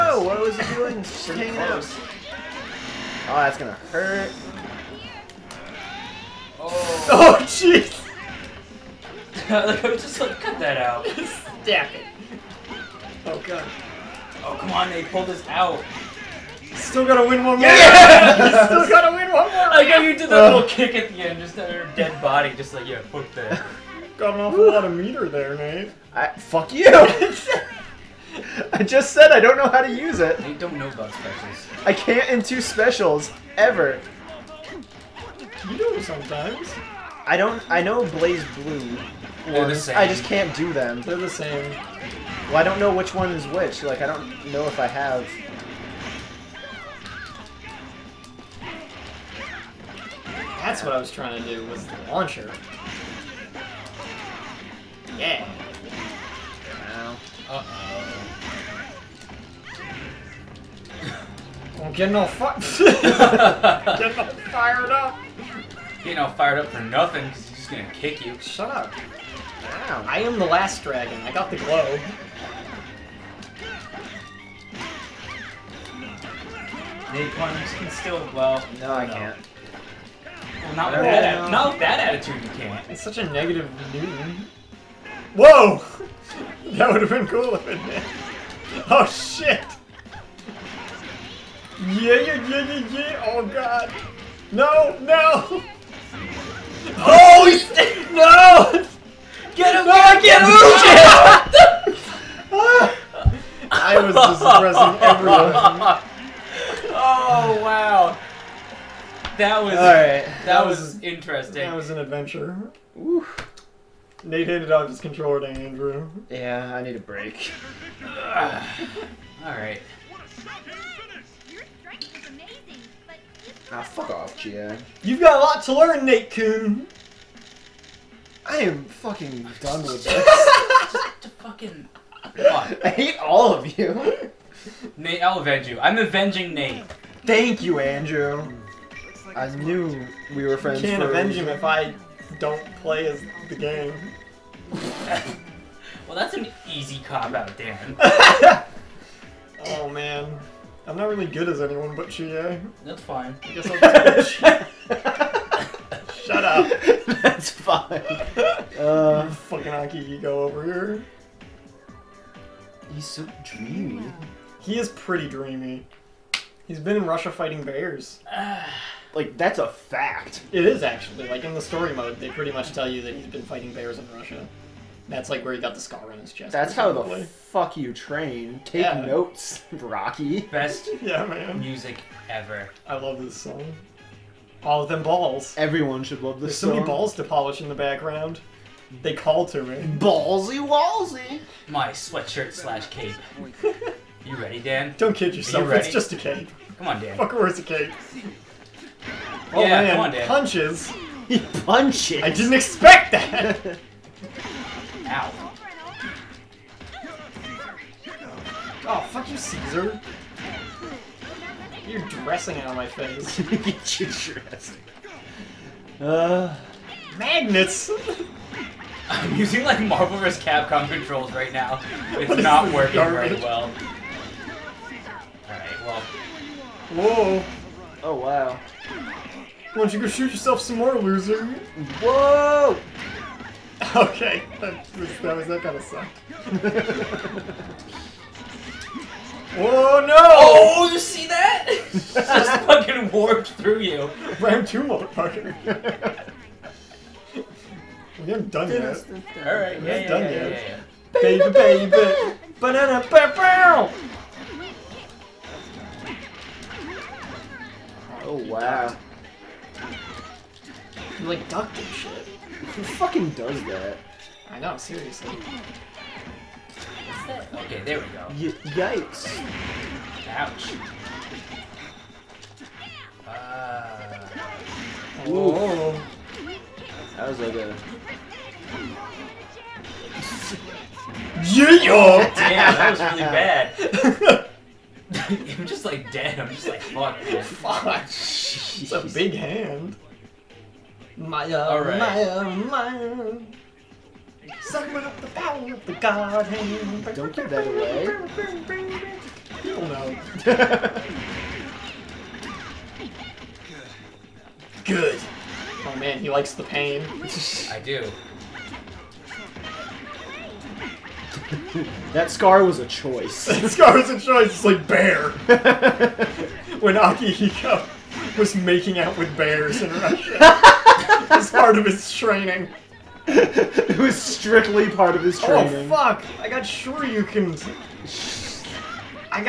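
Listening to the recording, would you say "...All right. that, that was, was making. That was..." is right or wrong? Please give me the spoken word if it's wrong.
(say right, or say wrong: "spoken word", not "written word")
wrong: "interesting", not "making".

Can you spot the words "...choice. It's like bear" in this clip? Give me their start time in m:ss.
5:14.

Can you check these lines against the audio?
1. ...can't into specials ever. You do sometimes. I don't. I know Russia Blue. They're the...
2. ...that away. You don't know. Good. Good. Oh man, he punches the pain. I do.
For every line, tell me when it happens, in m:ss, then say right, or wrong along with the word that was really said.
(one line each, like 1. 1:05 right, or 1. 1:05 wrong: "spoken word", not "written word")
1. 0:31 wrong: "Blaze", not "Russia"
2. 4:57 wrong: "likes", not "punches".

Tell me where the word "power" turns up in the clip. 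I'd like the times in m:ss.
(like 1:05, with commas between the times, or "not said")
4:55.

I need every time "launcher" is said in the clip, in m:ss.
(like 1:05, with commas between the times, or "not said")
0:52.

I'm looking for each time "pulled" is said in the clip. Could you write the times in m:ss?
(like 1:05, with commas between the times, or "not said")
0:15.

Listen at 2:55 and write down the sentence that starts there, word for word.
That's like where he got the scar on his chest.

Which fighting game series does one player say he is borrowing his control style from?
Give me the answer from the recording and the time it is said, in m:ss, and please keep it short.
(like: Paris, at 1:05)
Marvel vs. Capcom, at 3:39.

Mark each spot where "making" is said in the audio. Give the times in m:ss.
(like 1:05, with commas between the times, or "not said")
5:18.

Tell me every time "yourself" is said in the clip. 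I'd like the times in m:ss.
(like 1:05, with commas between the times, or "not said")
3:15, 3:50.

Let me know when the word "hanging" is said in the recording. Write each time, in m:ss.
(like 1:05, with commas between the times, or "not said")
0:01.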